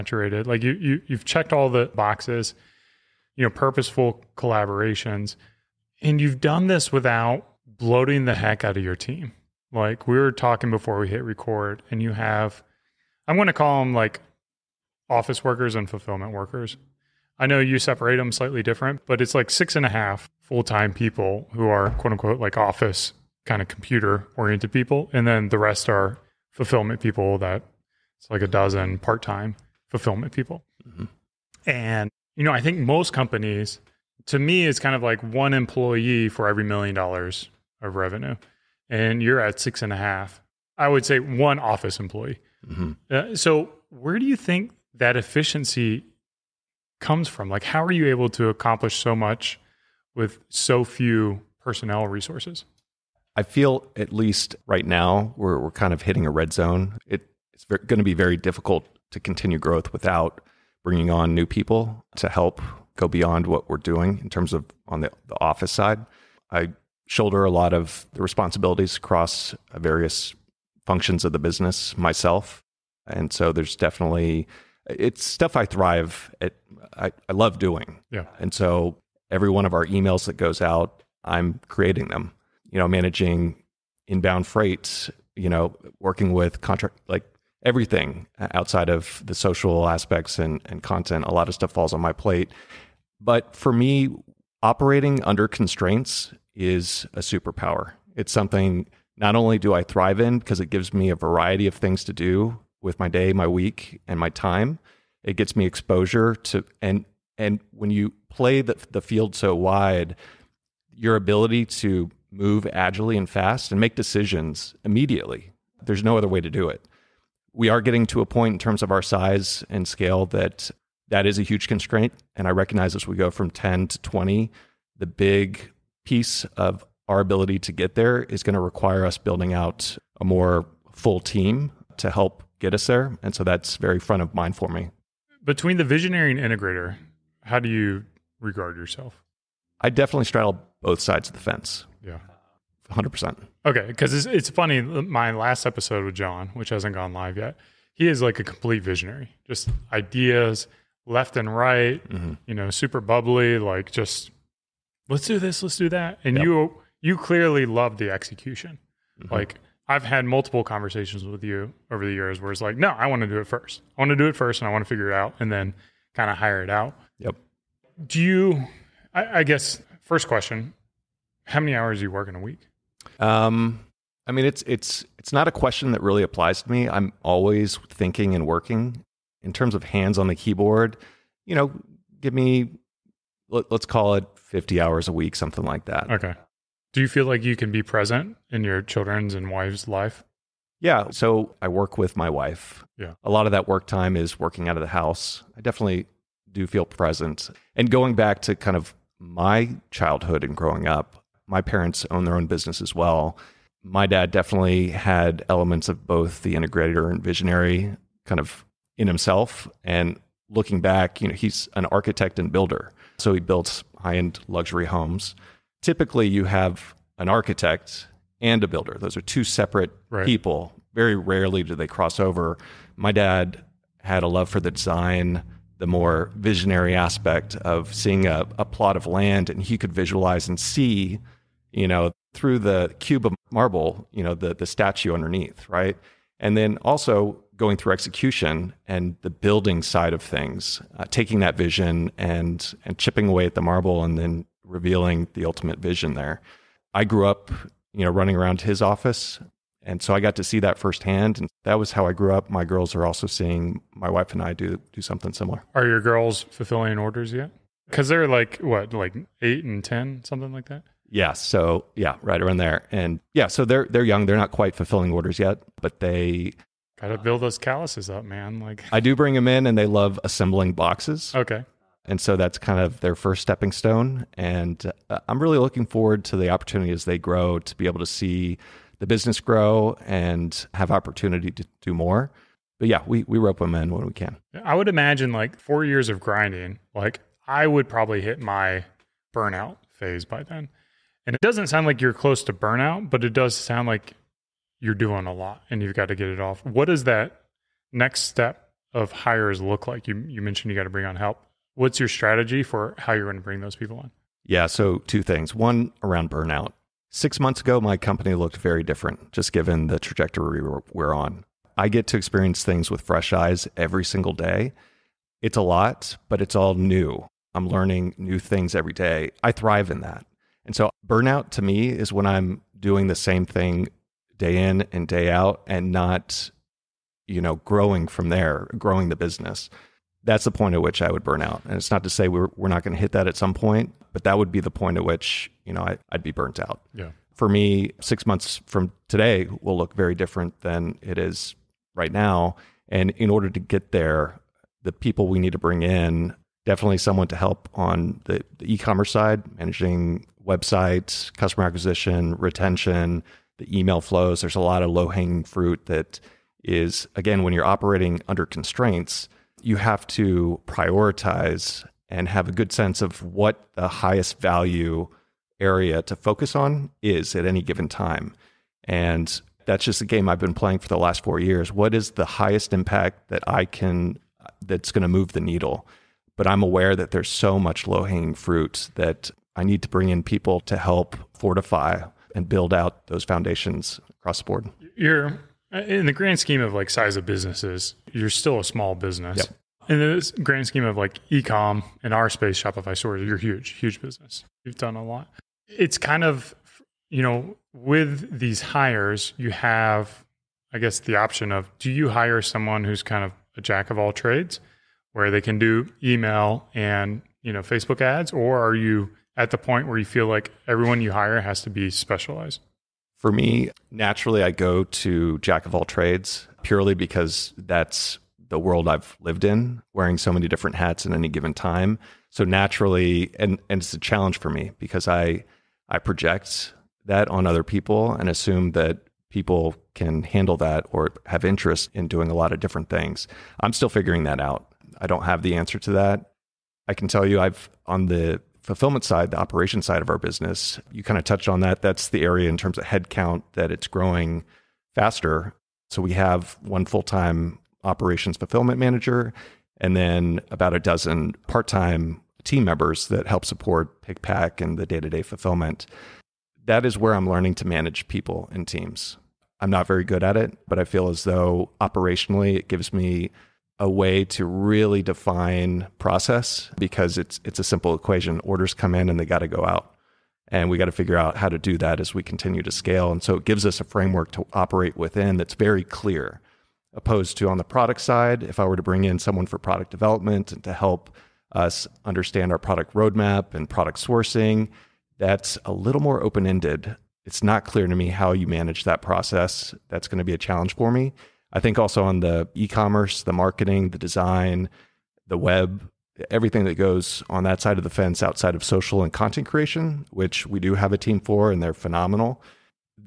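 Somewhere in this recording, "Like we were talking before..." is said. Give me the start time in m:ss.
0:09.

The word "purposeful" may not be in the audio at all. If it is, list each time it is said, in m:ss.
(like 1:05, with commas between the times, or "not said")
0:03.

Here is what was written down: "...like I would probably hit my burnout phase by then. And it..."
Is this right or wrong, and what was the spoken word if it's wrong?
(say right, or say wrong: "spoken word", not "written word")
right.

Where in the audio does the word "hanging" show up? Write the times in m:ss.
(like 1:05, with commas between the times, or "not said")
5:54, 6:18.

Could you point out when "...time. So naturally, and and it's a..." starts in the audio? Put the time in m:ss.
7:01.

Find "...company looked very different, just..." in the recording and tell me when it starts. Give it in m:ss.
5:07.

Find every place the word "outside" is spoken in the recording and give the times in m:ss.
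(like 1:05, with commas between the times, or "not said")
1:28, 8:18.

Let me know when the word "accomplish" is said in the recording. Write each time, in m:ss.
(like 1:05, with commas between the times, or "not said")
0:48.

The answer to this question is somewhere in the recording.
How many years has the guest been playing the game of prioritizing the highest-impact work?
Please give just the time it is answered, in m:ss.
6:11.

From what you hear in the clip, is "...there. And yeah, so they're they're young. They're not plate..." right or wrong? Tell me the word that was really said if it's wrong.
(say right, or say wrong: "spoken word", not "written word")
wrong: "quite", not "plate".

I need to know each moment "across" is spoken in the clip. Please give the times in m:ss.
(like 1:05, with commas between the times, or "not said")
1:08, 6:24.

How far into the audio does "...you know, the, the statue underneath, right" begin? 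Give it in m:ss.
3:54.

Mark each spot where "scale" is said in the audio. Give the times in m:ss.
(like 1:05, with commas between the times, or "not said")
1:59, 7:52.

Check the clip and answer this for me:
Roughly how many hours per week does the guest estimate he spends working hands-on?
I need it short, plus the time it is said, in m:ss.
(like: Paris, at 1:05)
50, at 3:04.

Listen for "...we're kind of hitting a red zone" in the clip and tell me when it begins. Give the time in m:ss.
0:55.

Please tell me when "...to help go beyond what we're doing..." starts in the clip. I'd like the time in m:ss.
1:02.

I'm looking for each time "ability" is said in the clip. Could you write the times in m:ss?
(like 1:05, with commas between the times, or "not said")
1:51, 2:07.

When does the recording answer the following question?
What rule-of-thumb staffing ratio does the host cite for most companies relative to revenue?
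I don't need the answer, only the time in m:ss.
0:35.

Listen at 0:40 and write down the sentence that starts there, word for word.
I would say one office employee.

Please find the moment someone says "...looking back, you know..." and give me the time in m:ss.
3:30.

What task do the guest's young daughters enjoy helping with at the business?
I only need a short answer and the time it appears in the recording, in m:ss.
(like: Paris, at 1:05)
Assembling boxes, at 4:30.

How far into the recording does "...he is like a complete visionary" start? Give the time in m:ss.
2:27.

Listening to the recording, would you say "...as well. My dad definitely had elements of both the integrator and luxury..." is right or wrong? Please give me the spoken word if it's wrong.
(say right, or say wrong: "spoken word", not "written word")
wrong: "visionary", not "luxury".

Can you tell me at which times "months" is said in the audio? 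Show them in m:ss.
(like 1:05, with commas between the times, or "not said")
5:07, 5:38.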